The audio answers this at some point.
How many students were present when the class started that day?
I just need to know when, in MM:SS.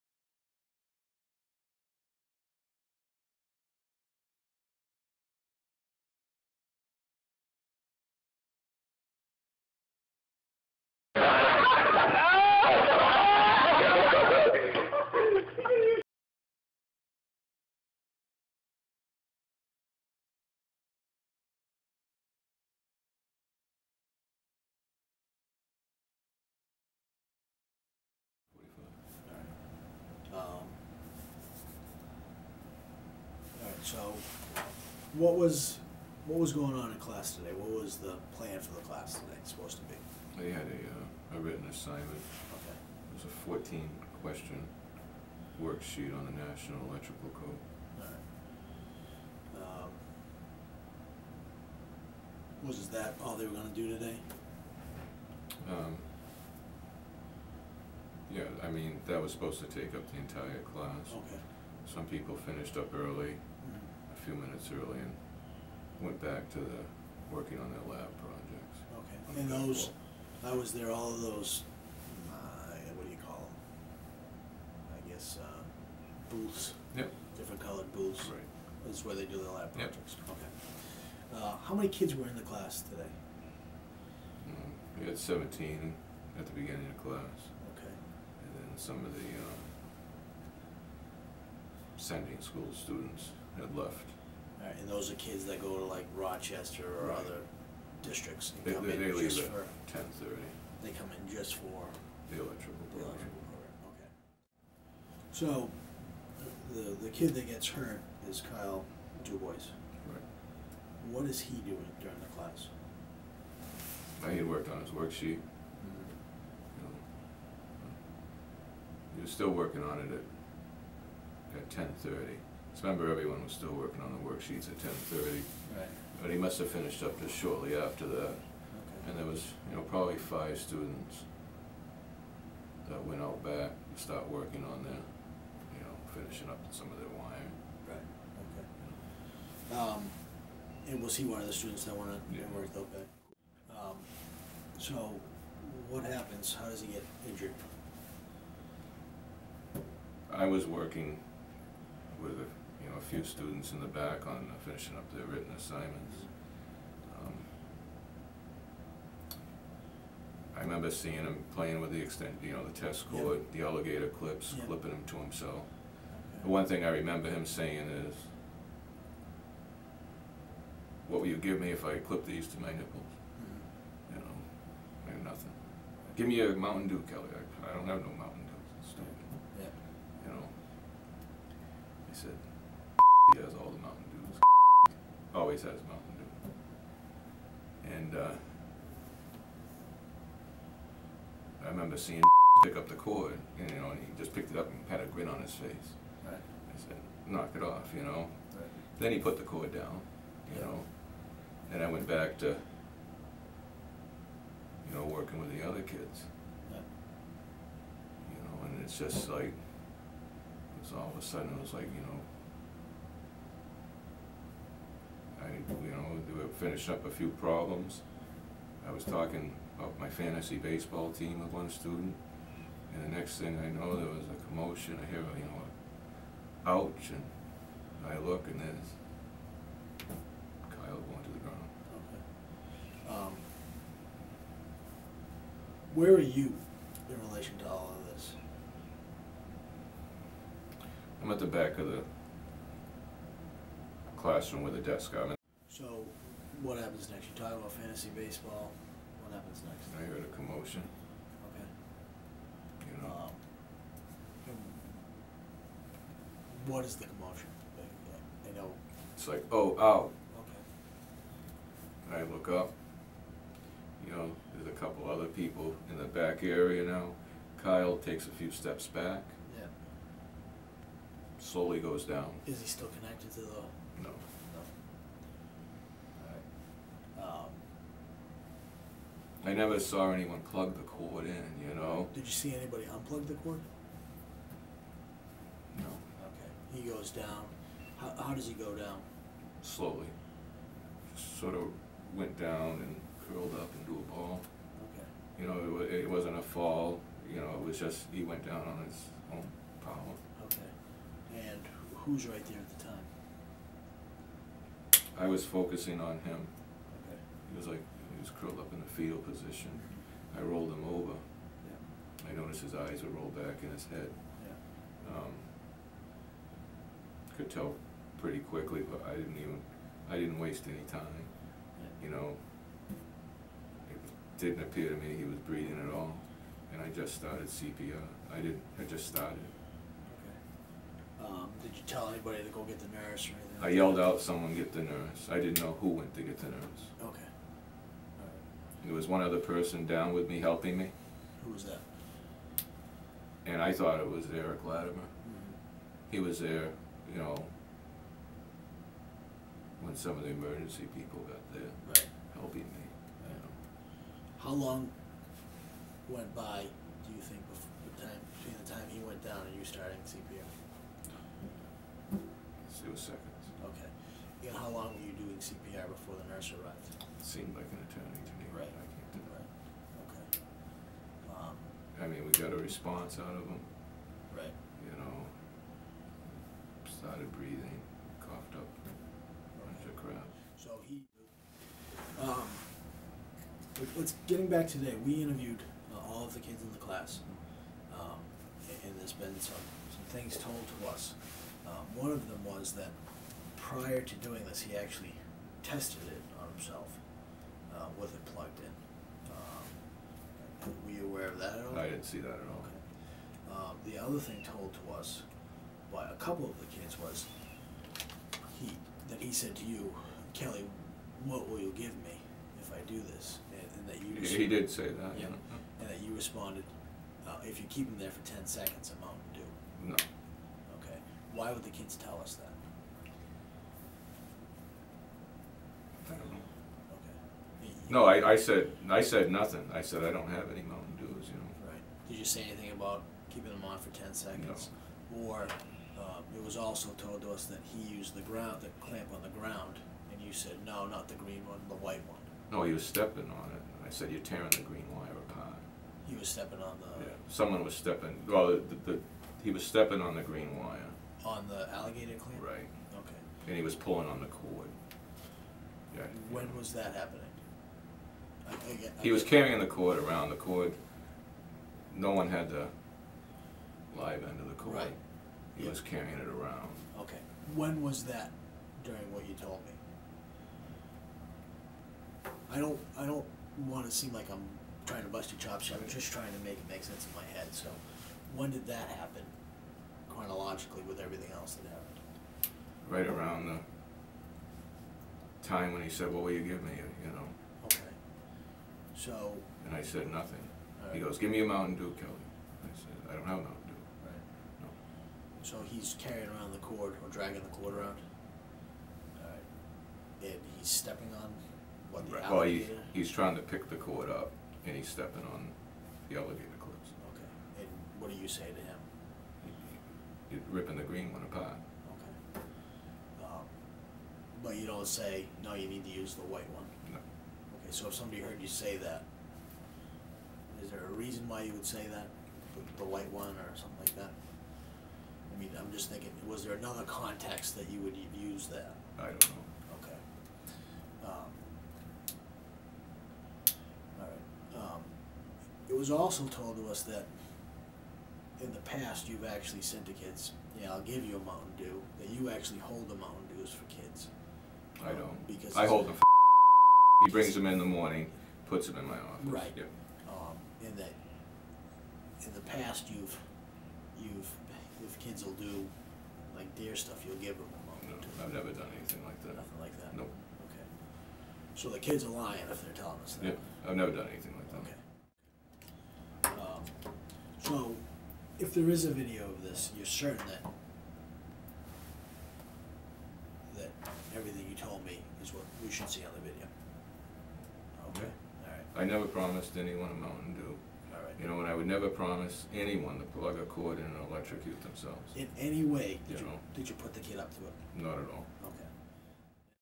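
01:25.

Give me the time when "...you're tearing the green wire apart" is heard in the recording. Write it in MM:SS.
07:24.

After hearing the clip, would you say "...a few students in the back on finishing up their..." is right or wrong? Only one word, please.
right.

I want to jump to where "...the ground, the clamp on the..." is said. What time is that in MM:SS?
07:18.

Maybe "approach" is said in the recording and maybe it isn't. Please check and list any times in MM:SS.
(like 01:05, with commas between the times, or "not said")
not said.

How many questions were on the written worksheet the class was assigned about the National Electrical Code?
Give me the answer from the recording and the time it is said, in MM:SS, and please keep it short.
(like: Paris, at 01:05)
14, at 00:43.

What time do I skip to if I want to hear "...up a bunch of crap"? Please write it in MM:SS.
06:18.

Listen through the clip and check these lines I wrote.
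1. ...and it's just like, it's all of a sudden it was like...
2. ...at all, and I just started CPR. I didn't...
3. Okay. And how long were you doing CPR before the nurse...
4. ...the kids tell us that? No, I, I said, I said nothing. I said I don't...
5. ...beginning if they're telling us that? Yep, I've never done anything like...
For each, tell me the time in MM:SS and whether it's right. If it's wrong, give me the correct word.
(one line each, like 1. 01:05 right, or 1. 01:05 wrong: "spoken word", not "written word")
1. 03:28 right
2. 05:25 right
3. 06:03 right
4. 07:01 right
5. 09:22 wrong: "lying", not "beginning".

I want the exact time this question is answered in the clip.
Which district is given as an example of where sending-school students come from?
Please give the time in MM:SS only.
01:36.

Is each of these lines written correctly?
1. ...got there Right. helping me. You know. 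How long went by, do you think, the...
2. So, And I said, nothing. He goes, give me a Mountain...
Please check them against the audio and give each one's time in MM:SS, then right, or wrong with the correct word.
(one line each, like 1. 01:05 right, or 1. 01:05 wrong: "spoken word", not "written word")
1. 05:51 right
2. 08:09 right.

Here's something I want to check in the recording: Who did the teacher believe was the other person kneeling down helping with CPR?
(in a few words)
Eric Latimer.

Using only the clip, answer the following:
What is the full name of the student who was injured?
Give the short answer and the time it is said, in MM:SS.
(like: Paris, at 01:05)
Kyle DuBois, at 01:48.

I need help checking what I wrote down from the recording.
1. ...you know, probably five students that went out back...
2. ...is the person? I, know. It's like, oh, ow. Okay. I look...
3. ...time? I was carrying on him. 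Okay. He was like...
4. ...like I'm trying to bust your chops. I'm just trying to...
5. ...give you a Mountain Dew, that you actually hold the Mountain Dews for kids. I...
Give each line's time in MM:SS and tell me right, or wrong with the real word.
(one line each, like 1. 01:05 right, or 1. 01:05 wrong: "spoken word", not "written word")
1. 02:09 right
2. 04:16 wrong: "commotion", not "person"
3. 05:02 wrong: "focusing", not "carrying"
4. 07:54 right
5. 09:00 right.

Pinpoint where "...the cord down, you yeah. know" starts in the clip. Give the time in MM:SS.
03:19.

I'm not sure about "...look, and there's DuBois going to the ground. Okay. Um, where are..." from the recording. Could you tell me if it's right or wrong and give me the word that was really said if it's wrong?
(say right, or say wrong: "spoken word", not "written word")
wrong: "Kyle", not "DuBois".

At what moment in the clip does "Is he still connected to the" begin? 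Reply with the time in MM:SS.
04:32.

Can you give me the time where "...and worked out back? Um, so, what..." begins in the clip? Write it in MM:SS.
02:22.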